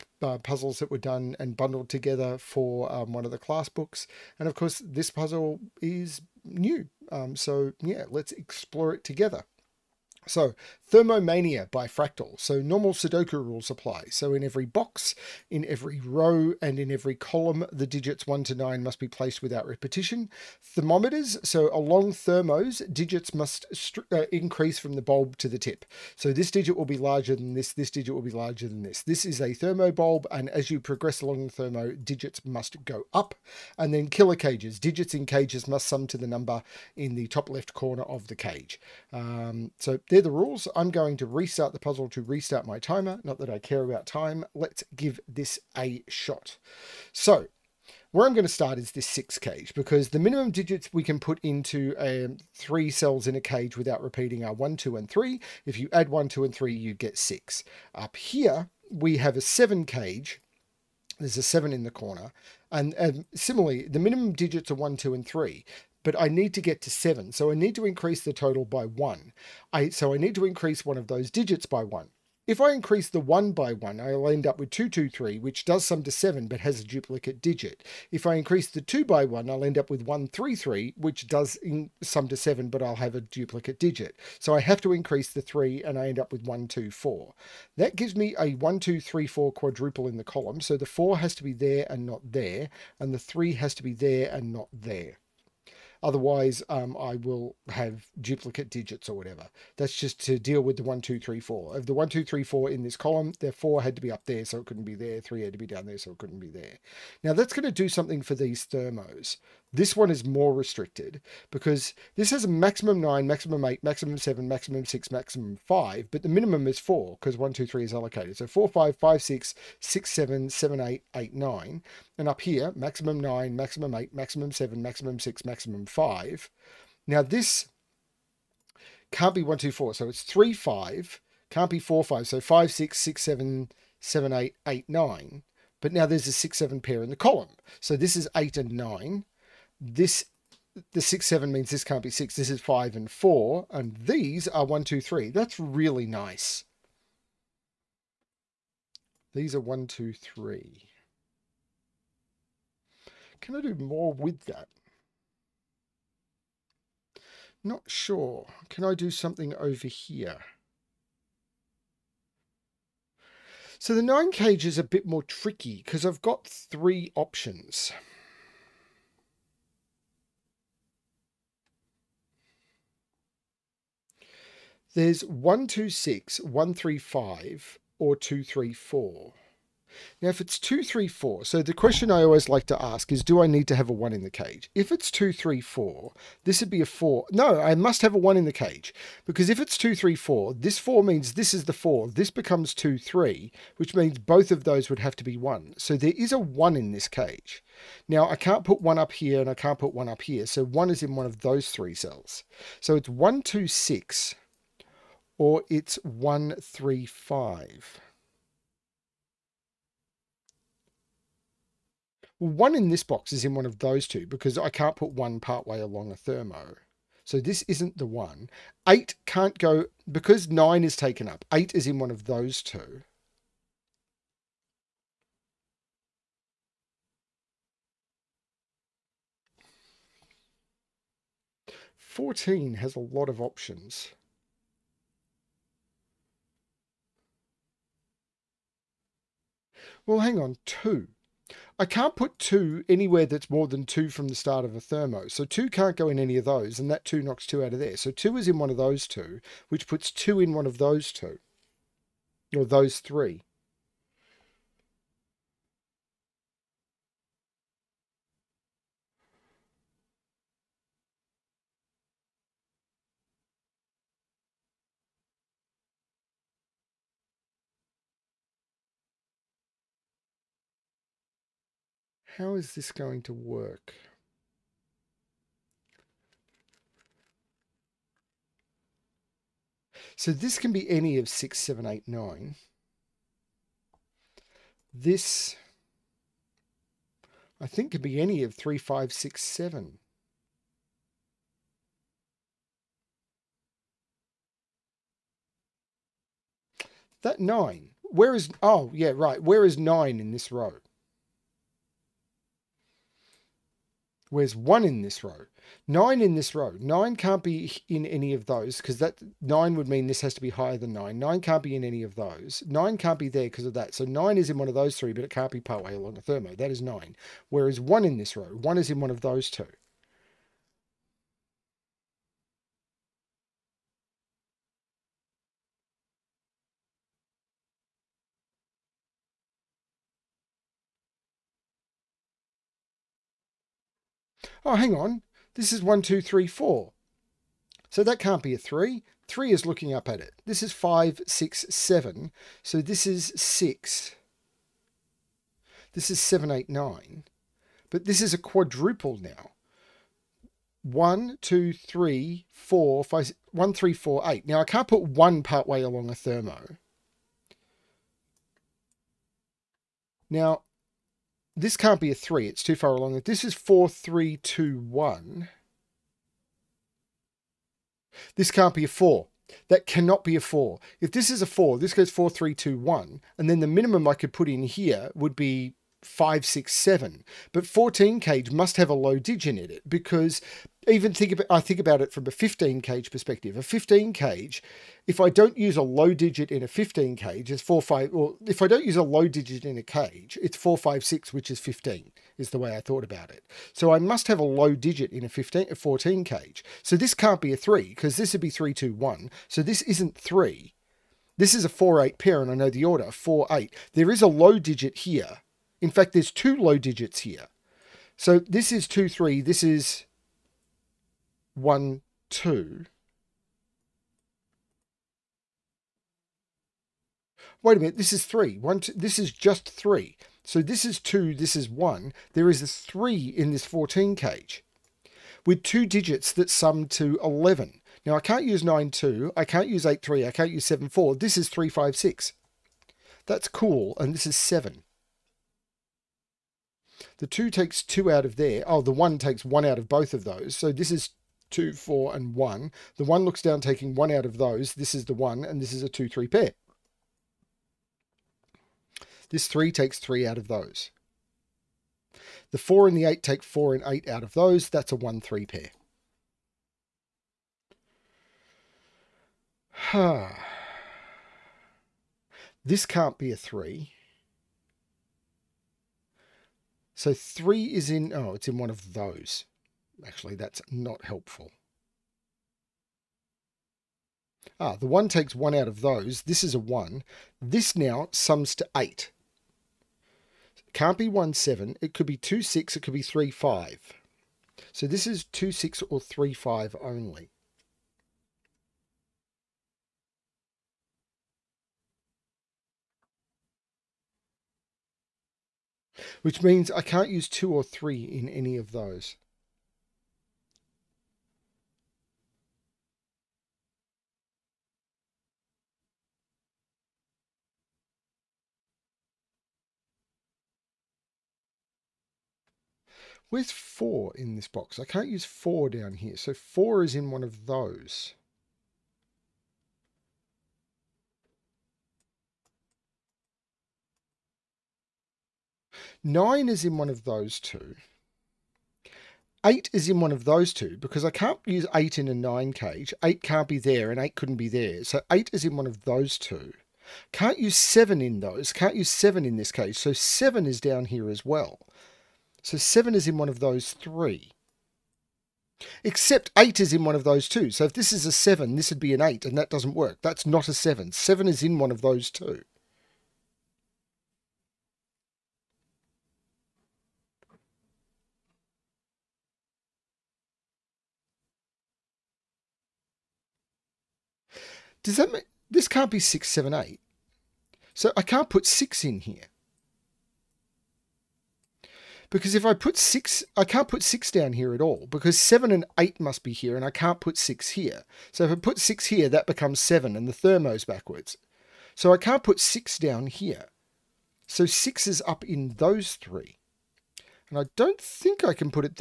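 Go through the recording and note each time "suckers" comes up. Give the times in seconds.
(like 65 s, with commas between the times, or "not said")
not said.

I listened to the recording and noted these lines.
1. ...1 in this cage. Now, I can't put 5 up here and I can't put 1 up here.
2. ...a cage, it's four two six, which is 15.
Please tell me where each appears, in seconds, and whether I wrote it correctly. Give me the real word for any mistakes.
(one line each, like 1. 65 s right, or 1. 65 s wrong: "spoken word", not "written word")
1. 196 s wrong: "1", not "5"
2. 389 s wrong: "five", not "two".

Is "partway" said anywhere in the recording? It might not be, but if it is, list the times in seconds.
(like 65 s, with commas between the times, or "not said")
215 s, 315 s, 355 s.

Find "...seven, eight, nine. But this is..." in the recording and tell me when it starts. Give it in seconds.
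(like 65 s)
346 s.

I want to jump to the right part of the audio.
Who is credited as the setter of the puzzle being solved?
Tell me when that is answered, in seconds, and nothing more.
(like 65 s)
11 s.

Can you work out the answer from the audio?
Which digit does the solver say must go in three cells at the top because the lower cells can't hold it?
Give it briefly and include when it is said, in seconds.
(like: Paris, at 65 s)
6, at 584 s.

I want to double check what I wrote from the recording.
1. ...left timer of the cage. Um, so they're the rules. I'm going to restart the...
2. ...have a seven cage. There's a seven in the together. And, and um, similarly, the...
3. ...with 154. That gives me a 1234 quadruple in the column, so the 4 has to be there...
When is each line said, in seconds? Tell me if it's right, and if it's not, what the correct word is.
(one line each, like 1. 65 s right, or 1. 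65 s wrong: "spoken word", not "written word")
1. 37 s wrong: "corner", not "timer"
2. 59 s wrong: "corner", not "together"
3. 86 s wrong: "124", not "154".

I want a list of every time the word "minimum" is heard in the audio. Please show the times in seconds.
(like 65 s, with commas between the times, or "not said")
50 s, 63 s, 116 s, 373 s.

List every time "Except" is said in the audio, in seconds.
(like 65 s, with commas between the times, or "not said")
545 s.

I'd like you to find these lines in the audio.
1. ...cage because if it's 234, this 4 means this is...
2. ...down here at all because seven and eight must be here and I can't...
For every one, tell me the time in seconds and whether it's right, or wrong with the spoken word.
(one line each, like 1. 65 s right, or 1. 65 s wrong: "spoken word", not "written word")
1. 188 s right
2. 574 s right.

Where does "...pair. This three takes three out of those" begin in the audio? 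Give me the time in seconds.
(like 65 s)
446 s.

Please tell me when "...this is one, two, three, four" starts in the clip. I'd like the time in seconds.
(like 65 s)
335 s.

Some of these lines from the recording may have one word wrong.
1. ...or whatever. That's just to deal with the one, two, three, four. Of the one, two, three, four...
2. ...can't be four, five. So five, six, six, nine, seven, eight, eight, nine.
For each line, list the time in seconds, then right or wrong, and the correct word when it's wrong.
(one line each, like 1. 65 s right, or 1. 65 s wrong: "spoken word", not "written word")
1. 99 s right
2. 131 s wrong: "seven", not "nine".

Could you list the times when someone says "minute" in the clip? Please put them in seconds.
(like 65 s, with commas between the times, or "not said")
417 s.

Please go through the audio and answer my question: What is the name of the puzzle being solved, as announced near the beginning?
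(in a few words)
Thermomania.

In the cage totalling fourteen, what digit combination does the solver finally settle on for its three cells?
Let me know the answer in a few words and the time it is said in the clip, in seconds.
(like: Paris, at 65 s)
3, 5, 6, at 431 s.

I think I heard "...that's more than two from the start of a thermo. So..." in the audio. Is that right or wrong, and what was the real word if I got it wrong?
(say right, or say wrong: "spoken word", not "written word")
right.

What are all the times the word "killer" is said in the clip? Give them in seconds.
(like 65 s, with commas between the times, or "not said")
34 s.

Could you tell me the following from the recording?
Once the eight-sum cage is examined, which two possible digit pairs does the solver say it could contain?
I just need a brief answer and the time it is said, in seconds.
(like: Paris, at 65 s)
2,6 or 3,5, at 485 s.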